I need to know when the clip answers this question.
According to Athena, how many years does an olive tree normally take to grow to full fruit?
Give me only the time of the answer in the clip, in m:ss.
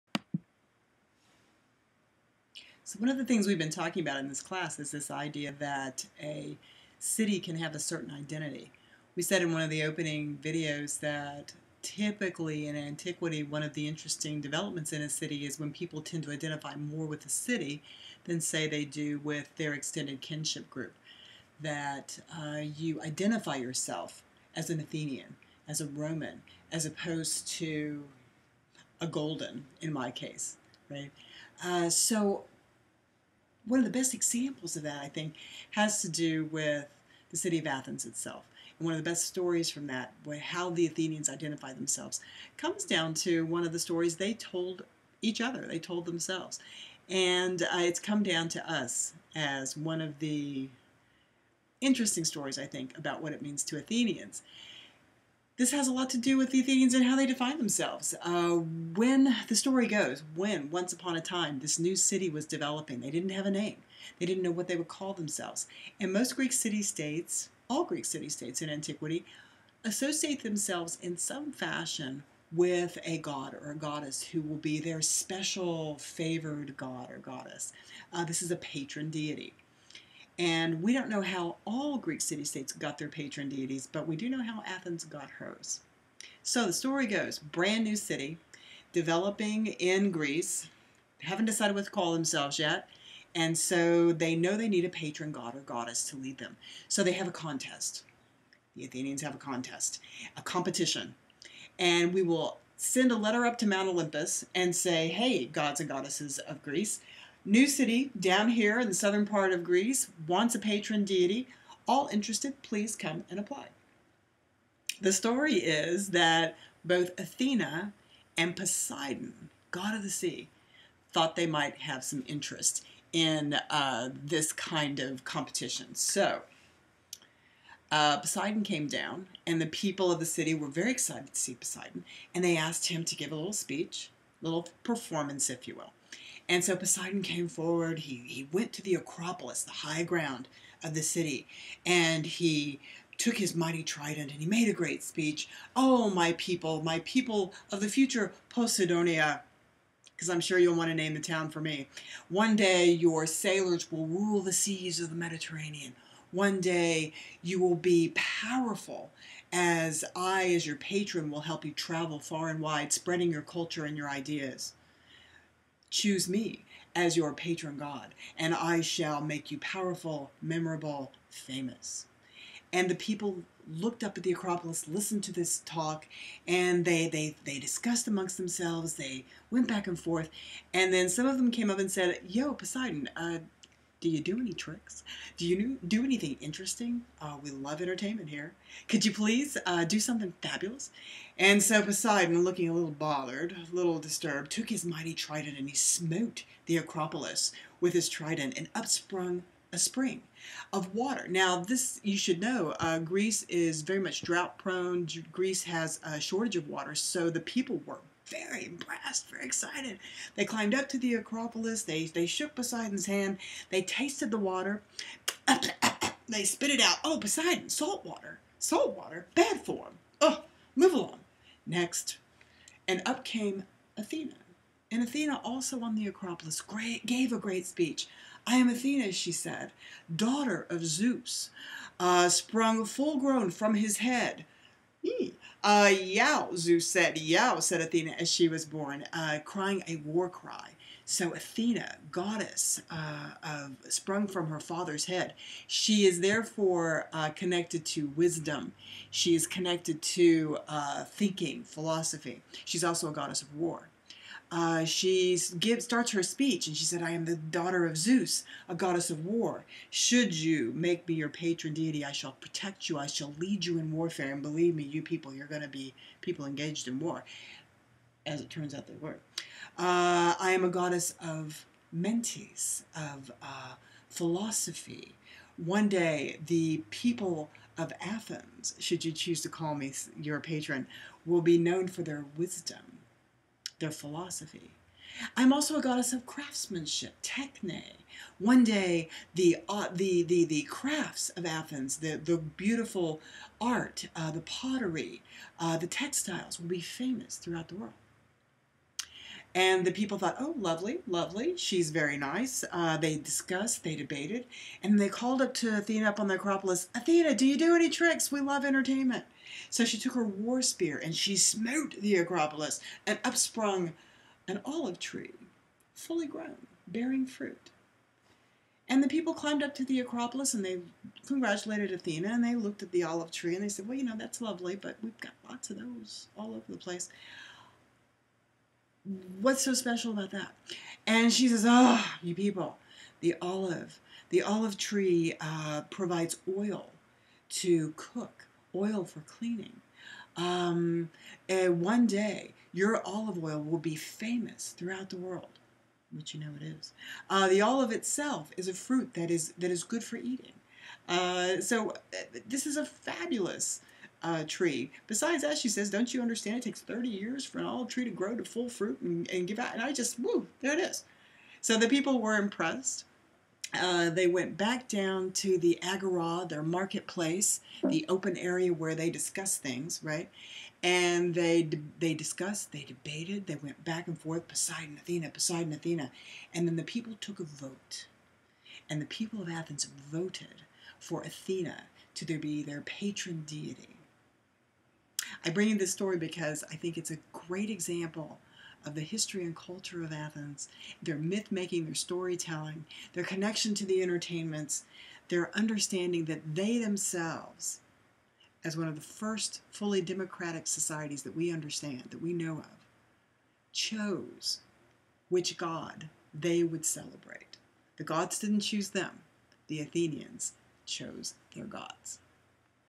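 5:56.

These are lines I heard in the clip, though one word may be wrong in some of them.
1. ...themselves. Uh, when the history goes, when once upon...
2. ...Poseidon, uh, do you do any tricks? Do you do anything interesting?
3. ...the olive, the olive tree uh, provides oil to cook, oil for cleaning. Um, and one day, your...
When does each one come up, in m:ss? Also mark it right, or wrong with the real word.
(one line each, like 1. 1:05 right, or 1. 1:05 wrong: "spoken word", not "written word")
1. 0:57 wrong: "story", not "history"
2. 3:02 right
3. 5:33 right.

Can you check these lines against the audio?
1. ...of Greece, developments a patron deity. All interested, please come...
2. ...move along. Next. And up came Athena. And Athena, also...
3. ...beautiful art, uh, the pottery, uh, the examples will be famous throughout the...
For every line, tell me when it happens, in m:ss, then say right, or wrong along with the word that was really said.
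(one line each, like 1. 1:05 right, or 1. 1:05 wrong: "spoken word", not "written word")
1. 1:49 wrong: "wants", not "developments"
2. 3:40 right
3. 4:52 wrong: "textiles", not "examples".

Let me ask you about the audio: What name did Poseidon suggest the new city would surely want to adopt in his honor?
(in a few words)
Posidonia.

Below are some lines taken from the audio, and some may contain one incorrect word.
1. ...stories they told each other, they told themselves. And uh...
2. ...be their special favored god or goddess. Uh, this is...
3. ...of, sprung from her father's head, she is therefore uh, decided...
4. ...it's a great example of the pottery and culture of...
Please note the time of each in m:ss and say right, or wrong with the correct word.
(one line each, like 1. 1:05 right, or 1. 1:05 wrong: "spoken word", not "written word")
1. 0:43 right
2. 1:14 right
3. 4:03 wrong: "connected", not "decided"
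4. 6:26 wrong: "history", not "pottery".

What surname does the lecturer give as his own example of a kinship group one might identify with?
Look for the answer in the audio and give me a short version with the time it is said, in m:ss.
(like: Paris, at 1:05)
Golden, at 0:29.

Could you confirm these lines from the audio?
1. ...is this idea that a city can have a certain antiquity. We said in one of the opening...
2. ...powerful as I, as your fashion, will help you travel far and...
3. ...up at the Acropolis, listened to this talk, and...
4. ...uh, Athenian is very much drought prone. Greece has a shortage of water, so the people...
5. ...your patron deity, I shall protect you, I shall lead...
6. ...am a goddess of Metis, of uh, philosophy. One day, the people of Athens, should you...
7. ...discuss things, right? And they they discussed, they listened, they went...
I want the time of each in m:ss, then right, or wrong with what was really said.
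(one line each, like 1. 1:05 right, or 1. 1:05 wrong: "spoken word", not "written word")
1. 0:04 wrong: "identity", not "antiquity"
2. 2:38 wrong: "patron", not "fashion"
3. 2:54 right
4. 3:22 wrong: "Greece", not "Athenian"
5. 4:21 right
6. 4:30 right
7. 6:09 wrong: "debated", not "listened".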